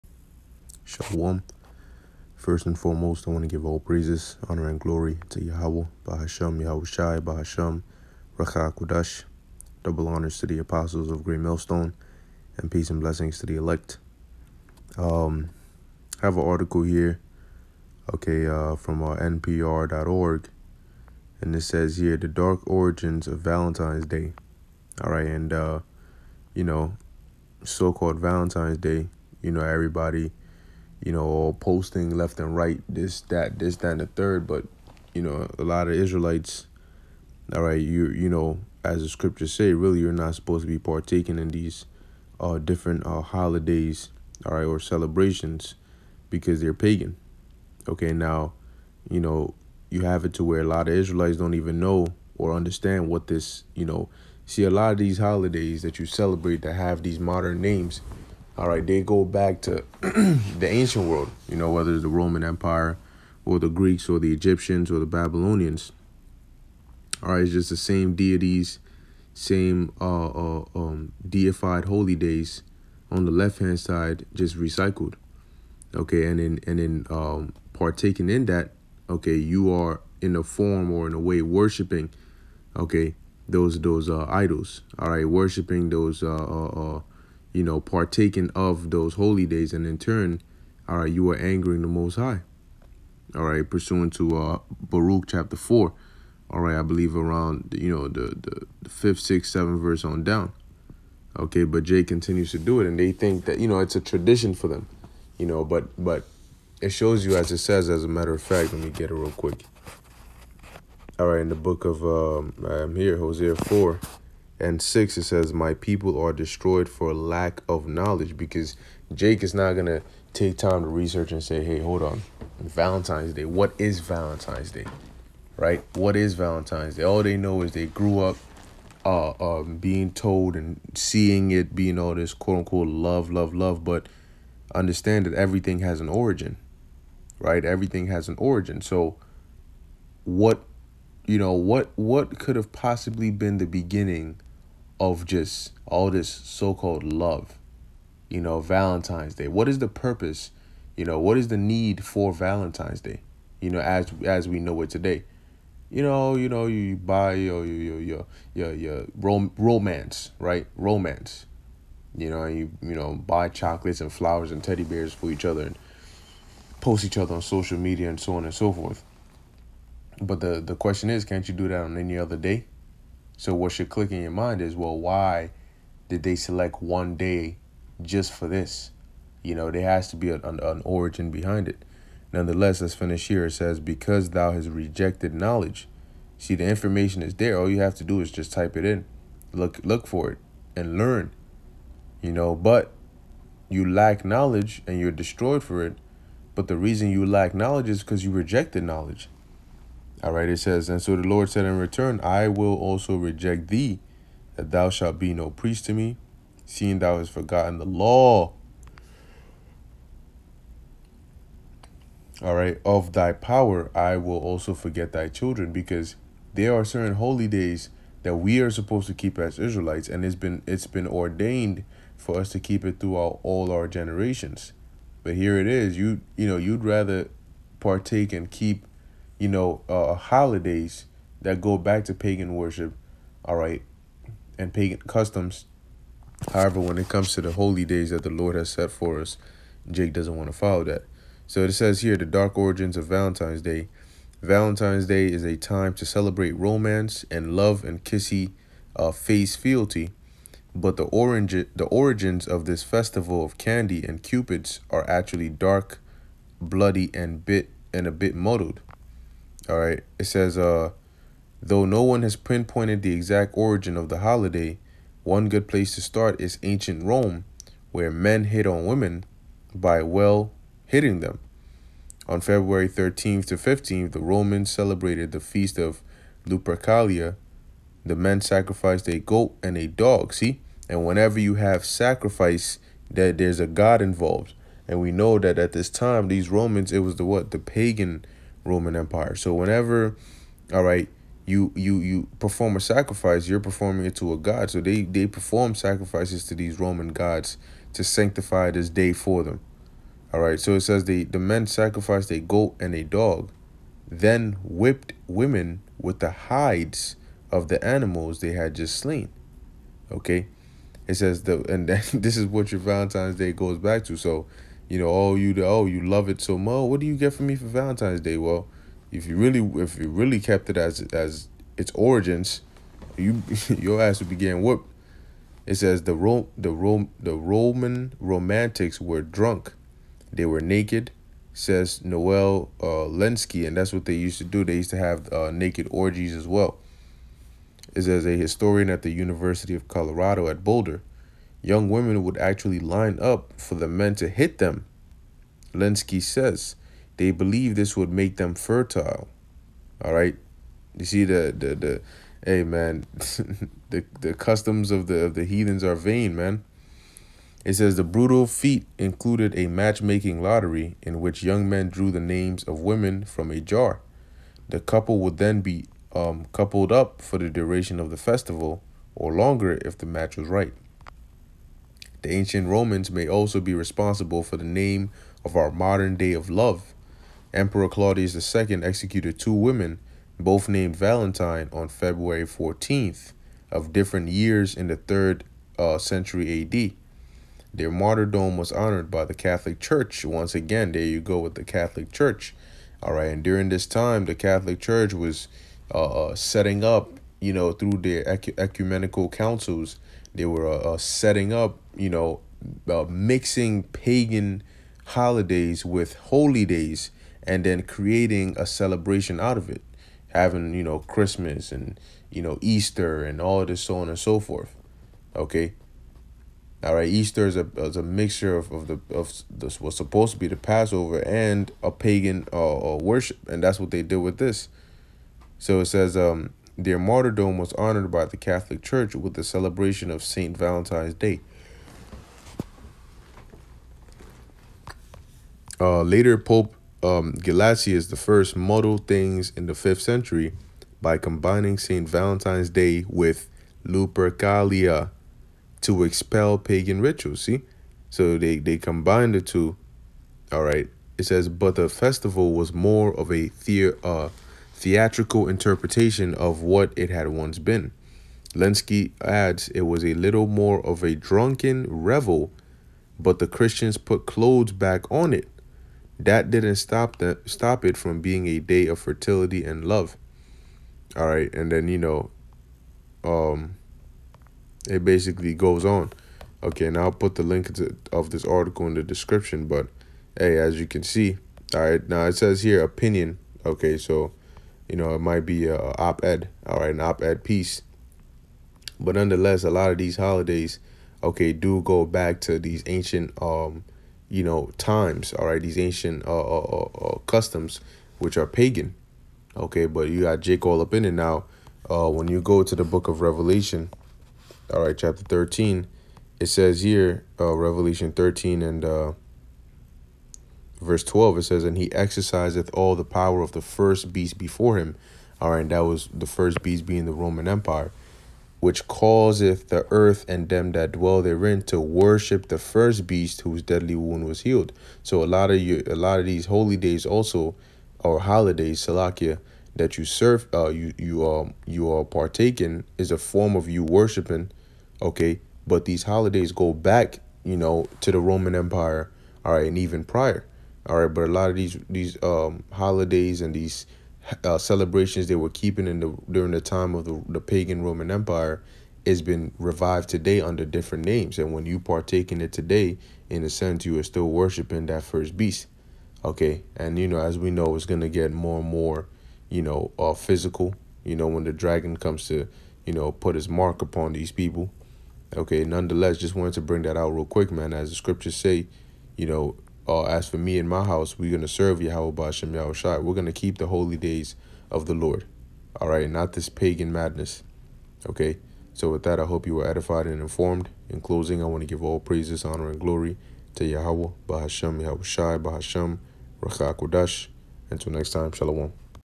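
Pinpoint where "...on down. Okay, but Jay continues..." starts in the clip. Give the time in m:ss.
1:40.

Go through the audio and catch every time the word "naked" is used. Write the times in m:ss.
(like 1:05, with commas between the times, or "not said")
5:30, 5:35.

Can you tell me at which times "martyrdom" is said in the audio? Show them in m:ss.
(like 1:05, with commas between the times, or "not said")
6:27, 7:06.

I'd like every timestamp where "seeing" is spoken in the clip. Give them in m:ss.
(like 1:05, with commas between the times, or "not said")
2:10, 3:26.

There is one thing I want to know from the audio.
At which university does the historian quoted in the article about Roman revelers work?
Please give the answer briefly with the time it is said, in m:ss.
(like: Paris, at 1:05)
University of Colorado at Boulder, at 5:39.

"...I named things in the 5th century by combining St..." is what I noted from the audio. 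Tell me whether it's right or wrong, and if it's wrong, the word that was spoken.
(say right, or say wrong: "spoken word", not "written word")
wrong: "muddled", not "named".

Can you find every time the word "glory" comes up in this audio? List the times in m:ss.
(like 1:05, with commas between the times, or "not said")
0:04, 9:42.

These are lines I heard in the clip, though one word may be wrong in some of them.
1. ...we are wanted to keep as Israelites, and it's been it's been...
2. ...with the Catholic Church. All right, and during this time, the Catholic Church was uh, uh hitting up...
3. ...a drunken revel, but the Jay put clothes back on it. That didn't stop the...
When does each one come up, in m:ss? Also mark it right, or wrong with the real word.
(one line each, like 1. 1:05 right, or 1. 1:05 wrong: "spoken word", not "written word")
1. 3:38 wrong: "supposed", not "wanted"
2. 6:31 wrong: "setting", not "hitting"
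3. 7:41 wrong: "Christians", not "Jay".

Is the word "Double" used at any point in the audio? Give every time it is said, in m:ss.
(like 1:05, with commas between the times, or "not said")
0:09.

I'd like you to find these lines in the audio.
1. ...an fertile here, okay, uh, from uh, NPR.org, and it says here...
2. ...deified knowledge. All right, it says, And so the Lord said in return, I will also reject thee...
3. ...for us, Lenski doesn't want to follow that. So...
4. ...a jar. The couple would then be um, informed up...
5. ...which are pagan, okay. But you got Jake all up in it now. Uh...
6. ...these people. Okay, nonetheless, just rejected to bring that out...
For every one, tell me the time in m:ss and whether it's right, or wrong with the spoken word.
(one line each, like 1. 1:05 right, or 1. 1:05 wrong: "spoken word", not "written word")
1. 0:16 wrong: "article", not "fertile"
2. 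3:18 wrong: "rejected", not "deified"
3. 3:58 wrong: "Jake", not "Lenski"
4. 6:03 wrong: "coupled", not "informed"
5. 8:18 right
6. 9:24 wrong: "wanted", not "rejected".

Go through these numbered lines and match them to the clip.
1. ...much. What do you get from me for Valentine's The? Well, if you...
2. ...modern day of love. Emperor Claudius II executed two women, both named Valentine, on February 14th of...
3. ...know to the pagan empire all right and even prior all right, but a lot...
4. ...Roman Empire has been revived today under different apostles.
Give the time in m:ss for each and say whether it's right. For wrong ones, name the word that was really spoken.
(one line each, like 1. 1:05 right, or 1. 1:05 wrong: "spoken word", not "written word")
1. 5:16 wrong: "Day", not "The"
2. 6:15 right
3. 8:57 wrong: "roman", not "pagan"
4. 9:07 wrong: "names", not "apostles".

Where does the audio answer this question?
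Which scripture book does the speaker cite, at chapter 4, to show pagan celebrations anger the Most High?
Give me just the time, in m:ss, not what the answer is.
1:34.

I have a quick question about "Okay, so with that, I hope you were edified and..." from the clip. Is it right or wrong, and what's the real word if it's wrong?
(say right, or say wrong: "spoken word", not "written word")
right.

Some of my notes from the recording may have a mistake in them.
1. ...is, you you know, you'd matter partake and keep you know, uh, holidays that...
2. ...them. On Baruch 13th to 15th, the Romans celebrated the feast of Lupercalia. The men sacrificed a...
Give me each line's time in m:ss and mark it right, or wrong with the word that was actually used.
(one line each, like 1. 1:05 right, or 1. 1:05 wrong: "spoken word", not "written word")
1. 3:45 wrong: "rather", not "matter"
2. 4:31 wrong: "February", not "Baruch".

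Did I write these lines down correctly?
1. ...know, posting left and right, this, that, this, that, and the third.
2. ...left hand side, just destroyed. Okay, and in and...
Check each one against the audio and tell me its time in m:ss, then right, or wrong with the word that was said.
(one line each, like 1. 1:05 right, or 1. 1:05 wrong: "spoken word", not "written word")
1. 0:31 right
2. 1:13 wrong: "recycled", not "destroyed".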